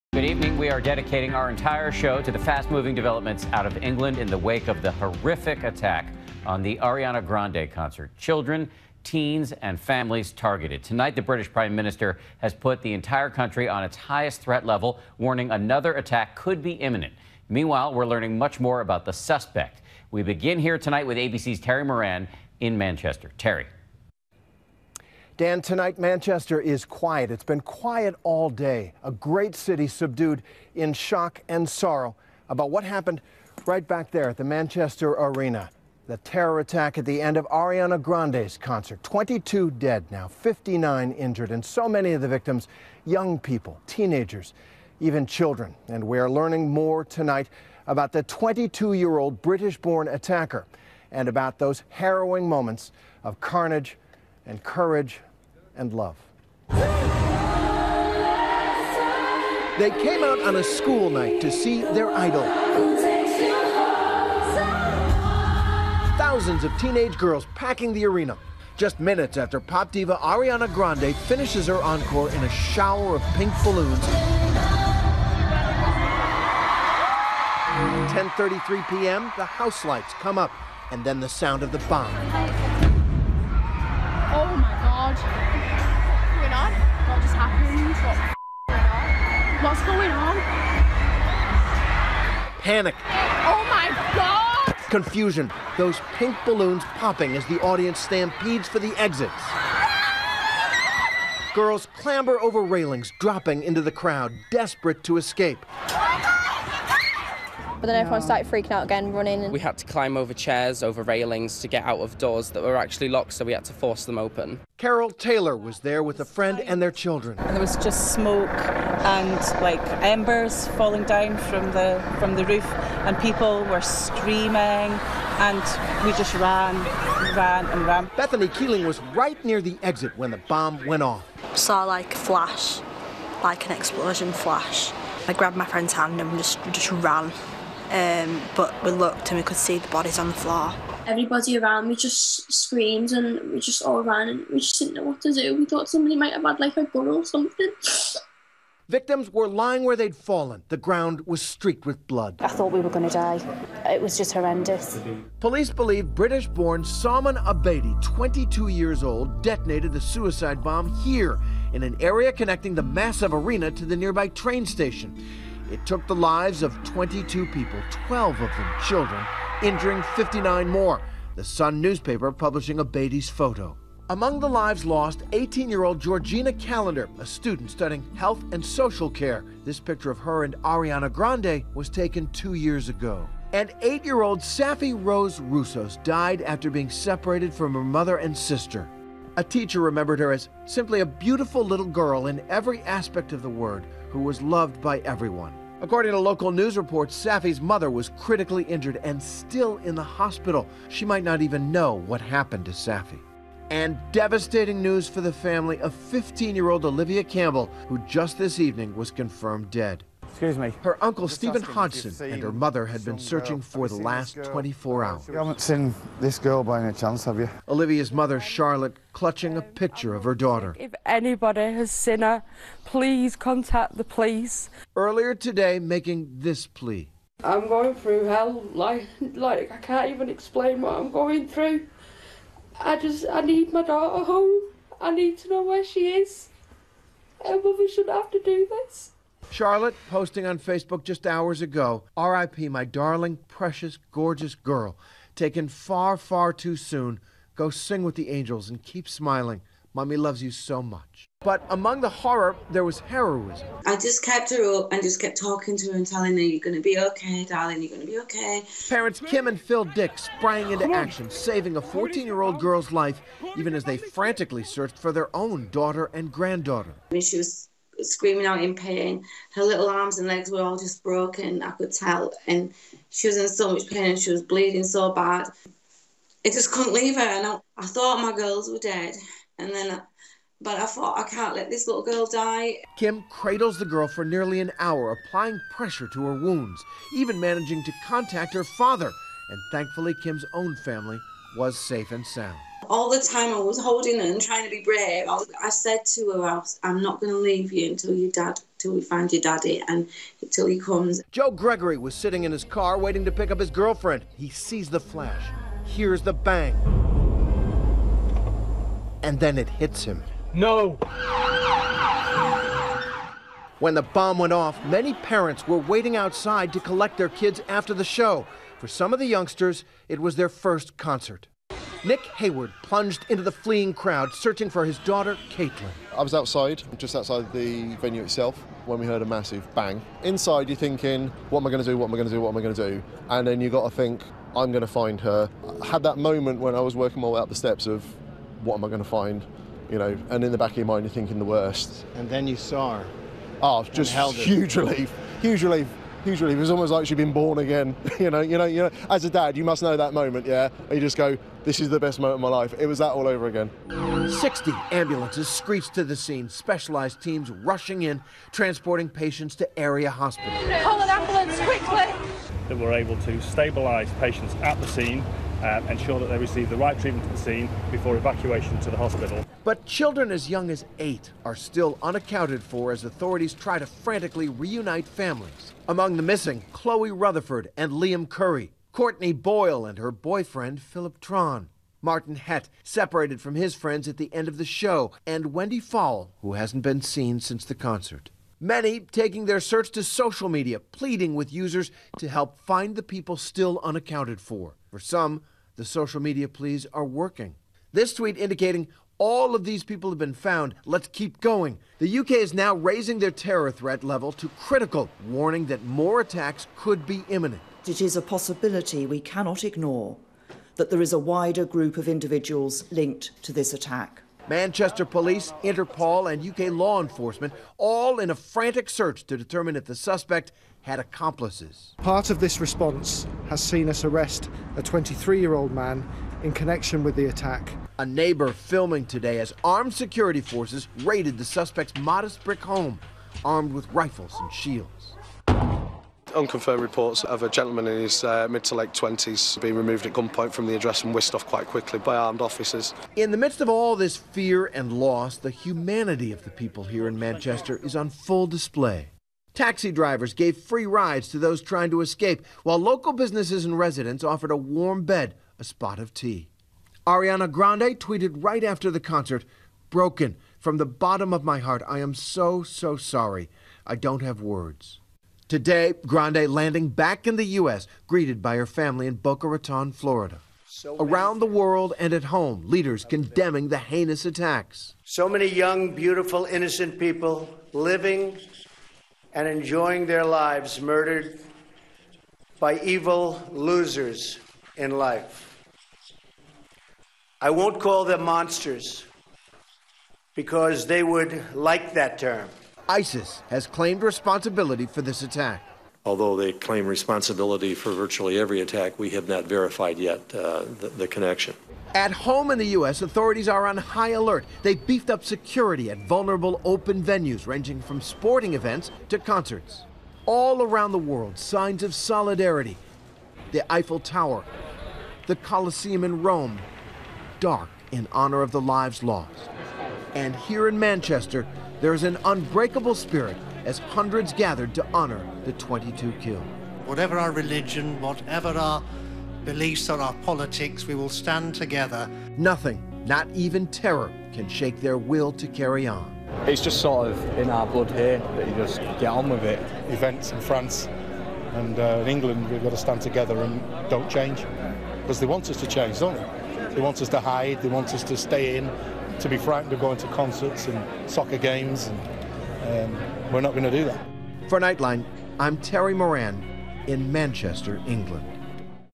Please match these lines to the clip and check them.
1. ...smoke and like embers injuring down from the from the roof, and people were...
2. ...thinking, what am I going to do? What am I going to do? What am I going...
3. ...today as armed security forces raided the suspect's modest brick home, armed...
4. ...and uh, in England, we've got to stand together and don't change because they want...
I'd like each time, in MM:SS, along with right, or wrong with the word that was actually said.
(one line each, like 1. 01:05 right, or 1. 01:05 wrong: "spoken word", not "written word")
1. 01:58 wrong: "falling", not "injuring"
2. 05:30 right
3. 07:09 right
4. 09:01 right.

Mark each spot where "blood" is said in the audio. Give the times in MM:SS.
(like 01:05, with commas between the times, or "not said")
02:32, 08:57.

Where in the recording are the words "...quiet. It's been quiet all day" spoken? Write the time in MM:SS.
00:26.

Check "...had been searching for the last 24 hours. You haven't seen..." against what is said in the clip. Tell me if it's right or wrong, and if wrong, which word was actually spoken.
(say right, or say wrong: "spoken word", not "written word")
right.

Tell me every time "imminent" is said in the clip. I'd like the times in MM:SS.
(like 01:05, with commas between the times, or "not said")
00:16, 06:47.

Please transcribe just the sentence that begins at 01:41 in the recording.
Girls clamber over railings, dropping into the crowd, desperate to escape.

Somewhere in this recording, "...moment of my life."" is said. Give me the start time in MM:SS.
05:52.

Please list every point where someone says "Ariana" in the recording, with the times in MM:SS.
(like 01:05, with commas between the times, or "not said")
00:06, 00:37, 01:10, 03:00, 07:37.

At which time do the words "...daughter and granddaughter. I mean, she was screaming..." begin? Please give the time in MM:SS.
04:25.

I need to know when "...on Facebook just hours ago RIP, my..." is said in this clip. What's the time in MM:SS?
04:00.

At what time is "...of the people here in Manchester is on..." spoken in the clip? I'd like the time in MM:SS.
07:26.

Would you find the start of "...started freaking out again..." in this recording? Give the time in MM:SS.
01:48.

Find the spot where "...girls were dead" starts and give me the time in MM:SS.
04:38.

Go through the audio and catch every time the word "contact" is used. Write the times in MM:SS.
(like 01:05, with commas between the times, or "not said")
03:43, 04:48.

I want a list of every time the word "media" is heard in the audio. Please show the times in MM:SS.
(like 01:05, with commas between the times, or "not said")
06:30, 06:36.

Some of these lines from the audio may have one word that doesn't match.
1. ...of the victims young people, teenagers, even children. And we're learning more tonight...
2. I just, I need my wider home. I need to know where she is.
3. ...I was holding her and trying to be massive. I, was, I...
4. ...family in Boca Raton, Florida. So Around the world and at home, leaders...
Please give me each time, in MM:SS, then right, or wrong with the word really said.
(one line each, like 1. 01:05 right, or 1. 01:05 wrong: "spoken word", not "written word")
1. 00:42 right
2. 03:52 wrong: "daughter", not "wider"
3. 04:53 wrong: "brave", not "massive"
4. 07:48 right.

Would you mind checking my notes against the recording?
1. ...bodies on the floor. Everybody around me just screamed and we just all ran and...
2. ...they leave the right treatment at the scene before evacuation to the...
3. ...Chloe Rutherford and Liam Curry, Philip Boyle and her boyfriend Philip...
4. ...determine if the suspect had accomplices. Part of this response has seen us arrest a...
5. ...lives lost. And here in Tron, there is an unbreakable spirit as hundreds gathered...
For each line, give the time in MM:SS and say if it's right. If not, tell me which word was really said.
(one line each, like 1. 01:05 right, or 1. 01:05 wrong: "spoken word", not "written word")
1. 02:19 right
2. 06:06 wrong: "receive", not "leave"
3. 06:16 wrong: "Courtney", not "Philip"
4. 06:59 right
5. 08:38 wrong: "Manchester", not "Tron".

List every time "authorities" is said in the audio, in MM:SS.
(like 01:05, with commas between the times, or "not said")
06:13, 08:23.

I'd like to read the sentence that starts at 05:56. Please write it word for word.
Specialized teams rushing in, transporting patients to area hospitals.